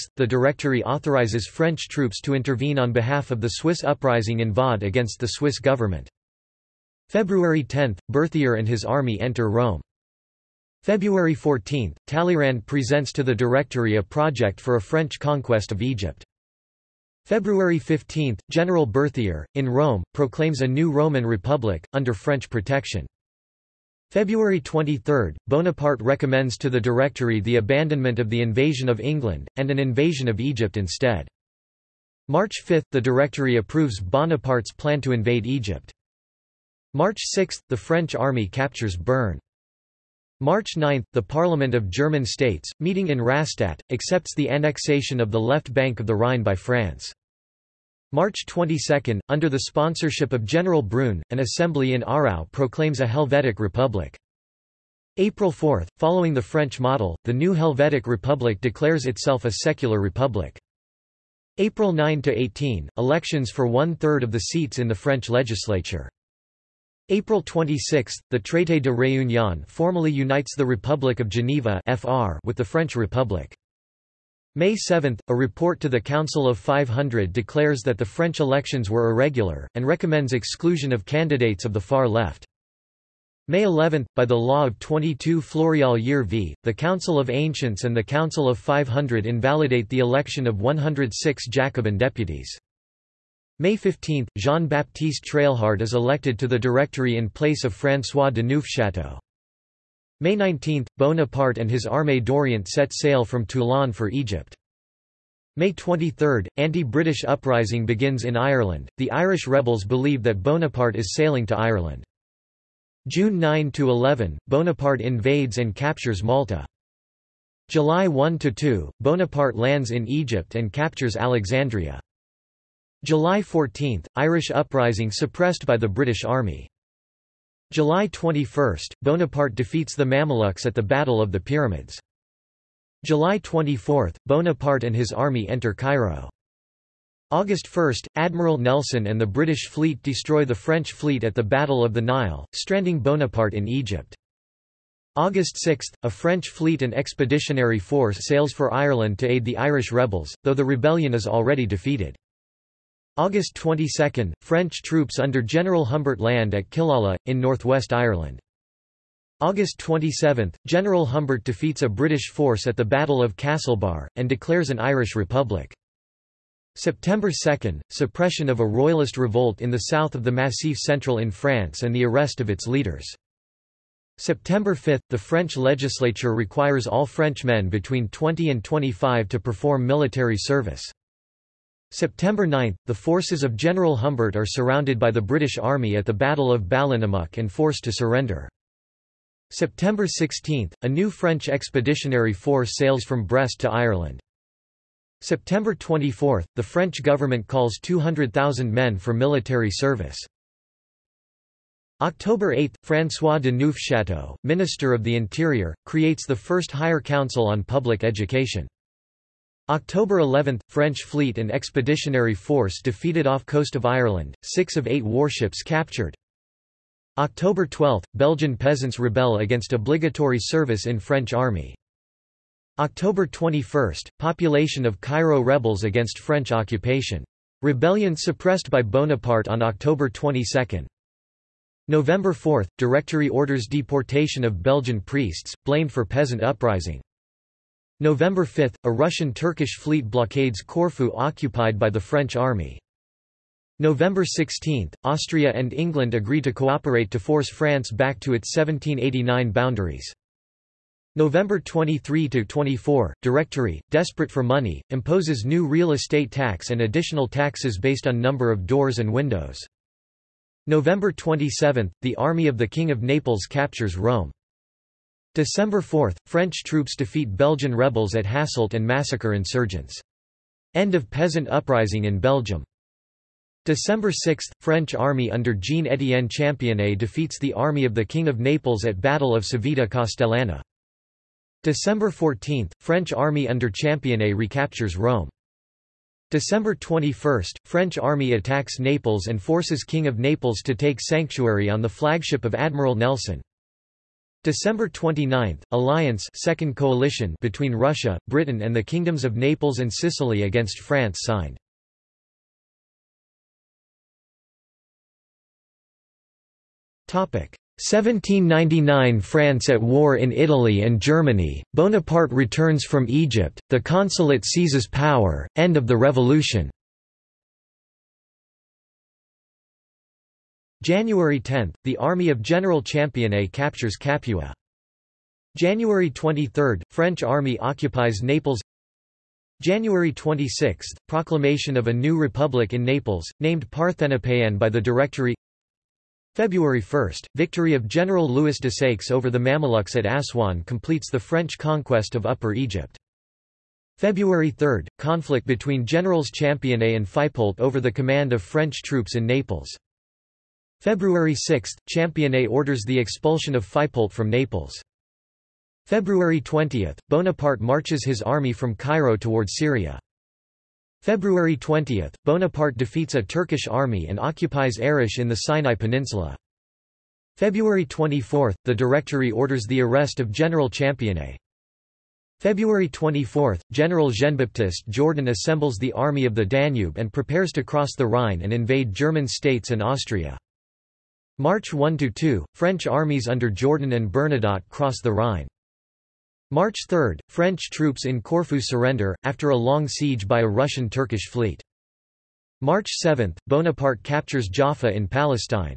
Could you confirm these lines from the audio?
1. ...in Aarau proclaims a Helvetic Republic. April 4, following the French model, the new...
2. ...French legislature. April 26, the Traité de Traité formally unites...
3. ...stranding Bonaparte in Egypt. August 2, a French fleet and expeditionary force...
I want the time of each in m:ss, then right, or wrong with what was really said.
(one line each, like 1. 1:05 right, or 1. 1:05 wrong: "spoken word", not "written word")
1. 0:51 right
2. 1:04 wrong: "Réunion", not "Traité"
3. 2:22 wrong: "6", not "2".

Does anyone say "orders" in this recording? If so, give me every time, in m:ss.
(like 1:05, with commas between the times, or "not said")
3:53, 5:52, 6:09.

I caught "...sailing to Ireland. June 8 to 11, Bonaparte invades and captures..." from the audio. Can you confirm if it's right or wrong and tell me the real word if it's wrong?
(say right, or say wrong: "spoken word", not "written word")
wrong: "9", not "8".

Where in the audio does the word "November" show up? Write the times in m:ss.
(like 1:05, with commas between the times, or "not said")
3:51, 3:58, 4:03, 4:11, 4:20.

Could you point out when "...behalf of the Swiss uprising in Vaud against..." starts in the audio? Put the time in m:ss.
0:02.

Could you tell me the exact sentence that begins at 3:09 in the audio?
September 16, a new French expeditionary force sails from Brest to Ireland.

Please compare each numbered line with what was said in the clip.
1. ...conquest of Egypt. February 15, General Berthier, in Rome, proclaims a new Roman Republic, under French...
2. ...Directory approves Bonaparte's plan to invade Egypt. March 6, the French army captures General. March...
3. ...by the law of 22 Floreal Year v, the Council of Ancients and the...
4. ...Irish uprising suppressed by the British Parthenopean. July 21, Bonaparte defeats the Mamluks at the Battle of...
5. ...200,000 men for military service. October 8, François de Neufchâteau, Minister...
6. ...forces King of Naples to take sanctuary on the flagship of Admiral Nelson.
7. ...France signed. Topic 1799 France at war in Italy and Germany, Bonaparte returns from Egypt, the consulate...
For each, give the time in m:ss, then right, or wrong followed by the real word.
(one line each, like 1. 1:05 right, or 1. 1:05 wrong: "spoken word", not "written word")
1. 0:15 right
2. 0:32 wrong: "Bern", not "General"
3. 1:24 right
4. 2:04 wrong: "Army", not "Parthenopean"
5. 3:17 right
6. 4:49 right
7. 5:00 right.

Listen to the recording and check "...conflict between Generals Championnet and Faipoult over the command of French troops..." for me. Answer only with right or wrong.
right.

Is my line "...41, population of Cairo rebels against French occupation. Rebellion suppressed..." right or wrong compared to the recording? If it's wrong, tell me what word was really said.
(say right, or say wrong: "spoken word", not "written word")
wrong: "21", not "41".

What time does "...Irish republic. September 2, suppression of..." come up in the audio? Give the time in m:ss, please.
2:44.